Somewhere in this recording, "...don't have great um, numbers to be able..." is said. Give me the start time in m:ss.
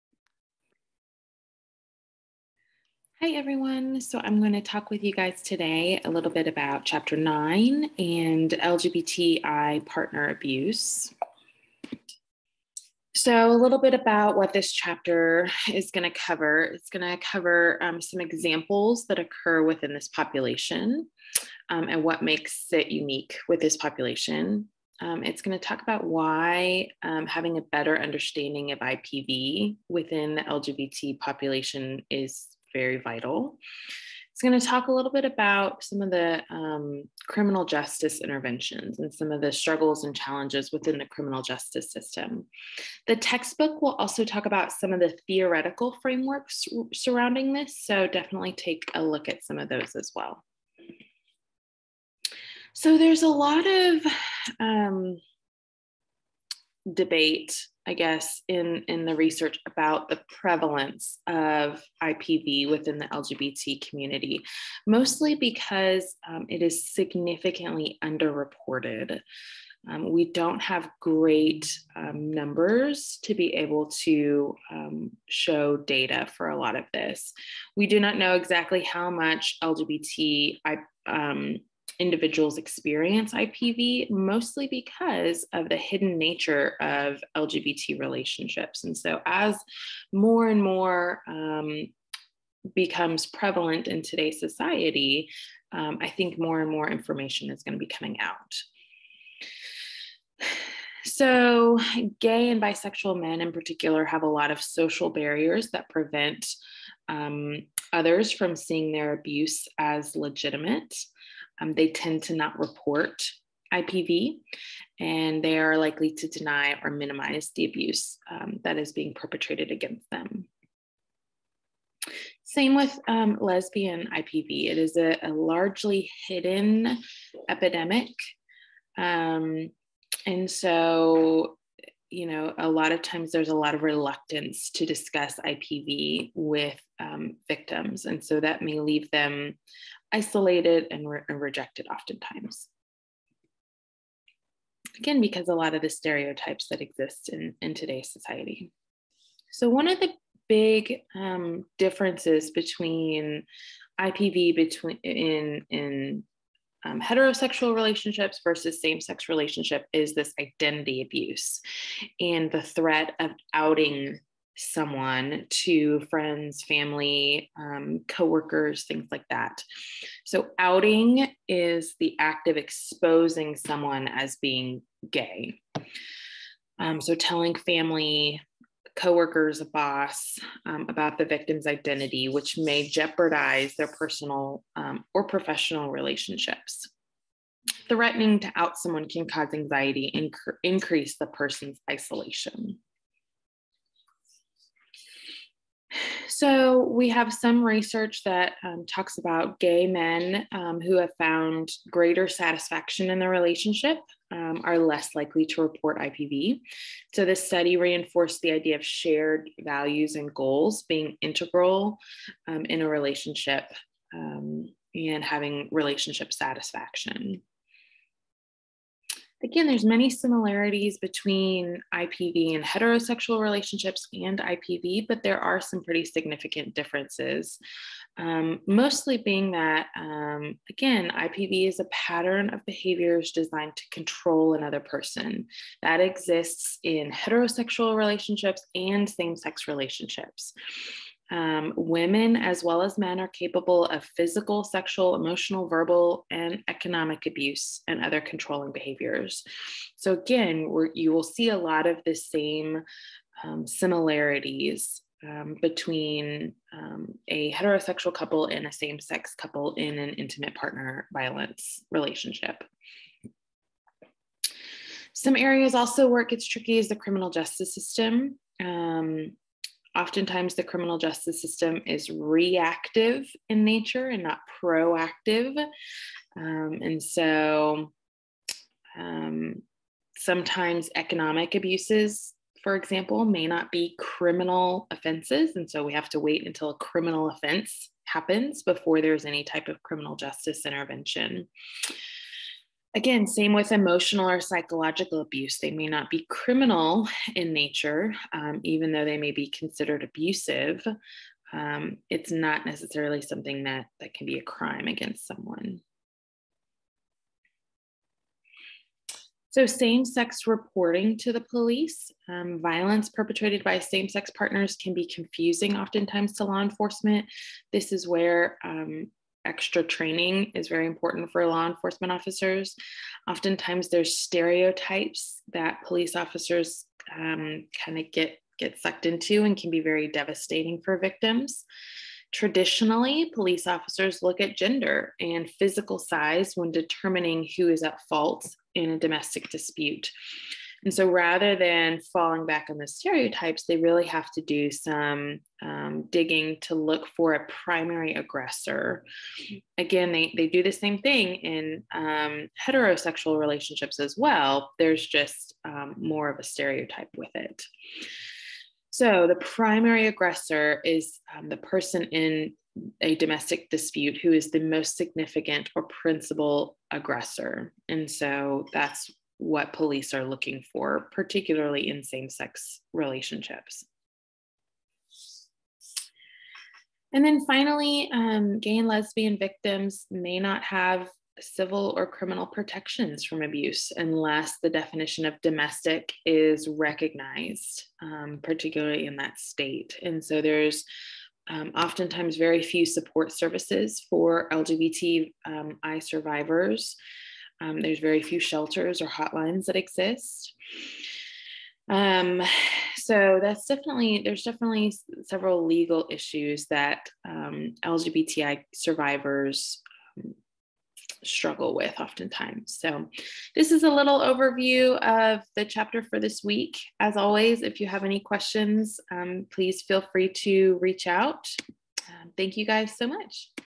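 1:10.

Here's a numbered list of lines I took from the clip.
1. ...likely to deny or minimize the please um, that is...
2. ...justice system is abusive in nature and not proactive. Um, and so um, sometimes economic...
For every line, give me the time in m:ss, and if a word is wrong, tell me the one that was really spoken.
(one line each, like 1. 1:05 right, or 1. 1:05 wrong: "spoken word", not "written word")
1. 1:55 wrong: "abuse", not "please"
2. 4:30 wrong: "reactive", not "abusive".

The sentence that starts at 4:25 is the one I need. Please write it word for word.
Some areas also where it gets tricky is the criminal justice system.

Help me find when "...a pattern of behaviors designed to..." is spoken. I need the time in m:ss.
3:51.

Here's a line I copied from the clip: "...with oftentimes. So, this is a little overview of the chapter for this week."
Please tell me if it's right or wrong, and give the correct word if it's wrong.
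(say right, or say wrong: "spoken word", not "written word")
right.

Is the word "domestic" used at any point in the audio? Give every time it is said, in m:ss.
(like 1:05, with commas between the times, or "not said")
5:38, 6:03, 6:25.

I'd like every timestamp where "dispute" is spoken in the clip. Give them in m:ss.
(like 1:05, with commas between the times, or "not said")
5:39, 6:03.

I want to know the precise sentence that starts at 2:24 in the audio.
Again, because a lot of the stereotypes that exist in, in today's society.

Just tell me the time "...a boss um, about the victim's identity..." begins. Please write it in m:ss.
2:59.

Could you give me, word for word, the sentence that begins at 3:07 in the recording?
Threatening to out someone can cause anxiety and increase the person's isolation.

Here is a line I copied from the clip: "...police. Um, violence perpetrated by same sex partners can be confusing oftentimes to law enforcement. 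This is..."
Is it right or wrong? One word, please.
right.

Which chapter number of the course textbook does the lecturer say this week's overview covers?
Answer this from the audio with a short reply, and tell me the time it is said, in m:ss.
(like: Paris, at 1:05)
9, at 0:06.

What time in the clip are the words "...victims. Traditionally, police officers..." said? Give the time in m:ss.
5:30.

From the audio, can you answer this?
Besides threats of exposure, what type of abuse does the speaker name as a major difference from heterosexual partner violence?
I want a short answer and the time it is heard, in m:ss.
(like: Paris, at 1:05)
Identity abuse, at 2:40.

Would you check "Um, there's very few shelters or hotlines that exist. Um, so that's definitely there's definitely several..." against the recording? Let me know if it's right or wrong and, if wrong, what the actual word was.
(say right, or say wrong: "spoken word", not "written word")
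right.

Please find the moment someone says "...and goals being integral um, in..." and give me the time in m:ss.
3:30.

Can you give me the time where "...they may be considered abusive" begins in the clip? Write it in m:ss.
4:59.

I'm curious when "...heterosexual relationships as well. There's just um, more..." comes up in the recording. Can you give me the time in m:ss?
5:52.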